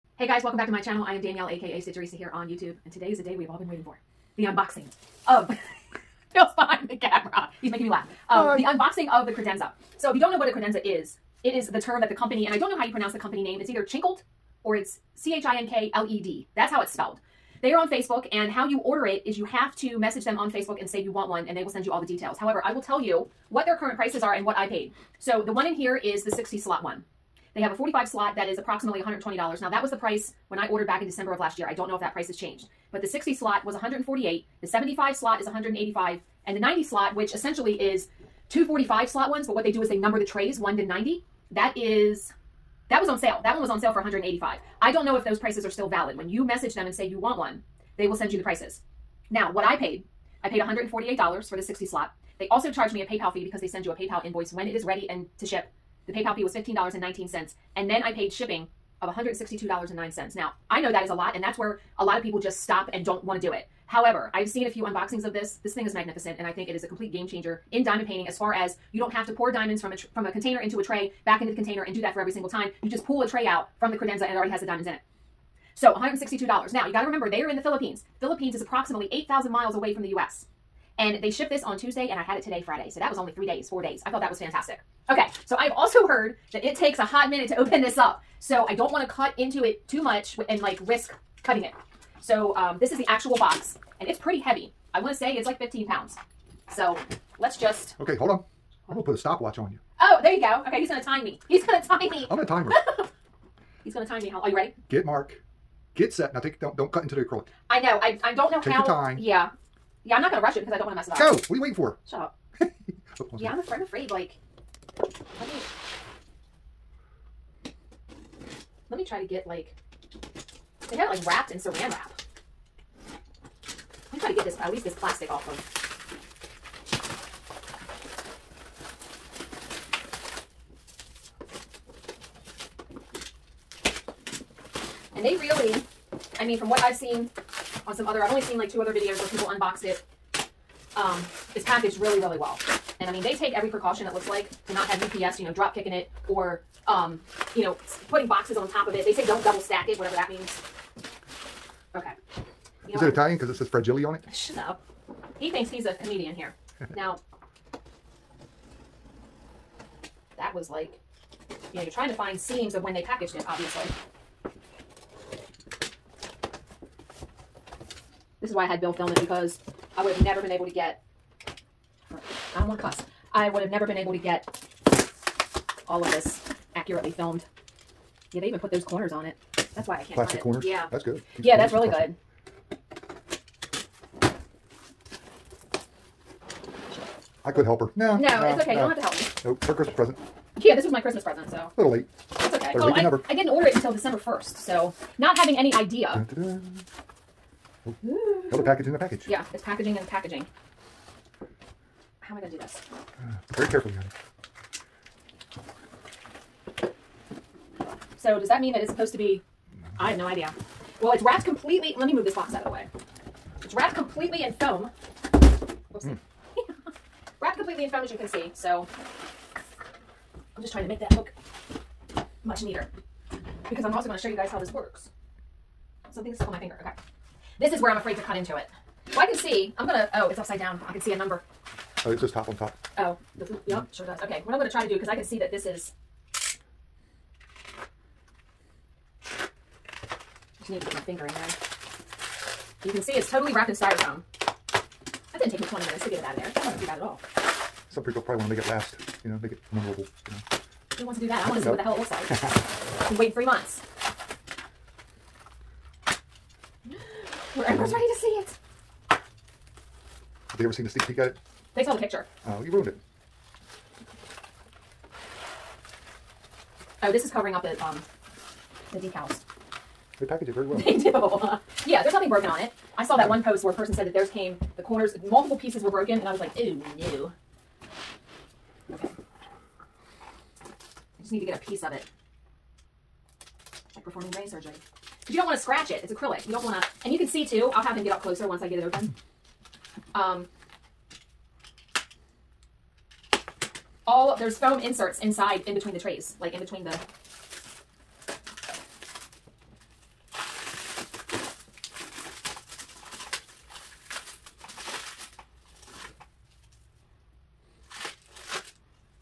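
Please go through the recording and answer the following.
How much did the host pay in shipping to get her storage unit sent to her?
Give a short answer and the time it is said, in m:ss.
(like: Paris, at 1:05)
$162.09, at 0:59.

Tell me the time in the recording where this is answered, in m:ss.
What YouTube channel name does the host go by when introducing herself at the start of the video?
0:01.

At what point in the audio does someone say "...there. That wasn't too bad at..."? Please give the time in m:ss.
4:06.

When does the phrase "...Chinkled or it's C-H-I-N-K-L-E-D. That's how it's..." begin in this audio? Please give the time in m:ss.
0:13.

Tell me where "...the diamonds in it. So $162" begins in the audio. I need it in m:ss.
1:14.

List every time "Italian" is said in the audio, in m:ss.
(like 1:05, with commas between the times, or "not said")
2:33.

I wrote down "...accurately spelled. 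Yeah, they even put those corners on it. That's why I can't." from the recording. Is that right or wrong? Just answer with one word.
wrong.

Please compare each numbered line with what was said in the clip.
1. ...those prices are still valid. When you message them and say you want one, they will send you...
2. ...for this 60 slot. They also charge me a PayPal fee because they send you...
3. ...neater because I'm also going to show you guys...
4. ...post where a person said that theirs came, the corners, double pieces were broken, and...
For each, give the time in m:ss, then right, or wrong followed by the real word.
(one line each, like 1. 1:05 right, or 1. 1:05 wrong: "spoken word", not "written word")
1. 0:45 right
2. 0:51 right
3. 3:42 right
4. 4:33 wrong: "multiple", not "double".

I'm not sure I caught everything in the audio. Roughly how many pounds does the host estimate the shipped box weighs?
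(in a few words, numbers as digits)
15.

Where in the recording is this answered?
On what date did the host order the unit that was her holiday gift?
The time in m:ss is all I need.
3:13.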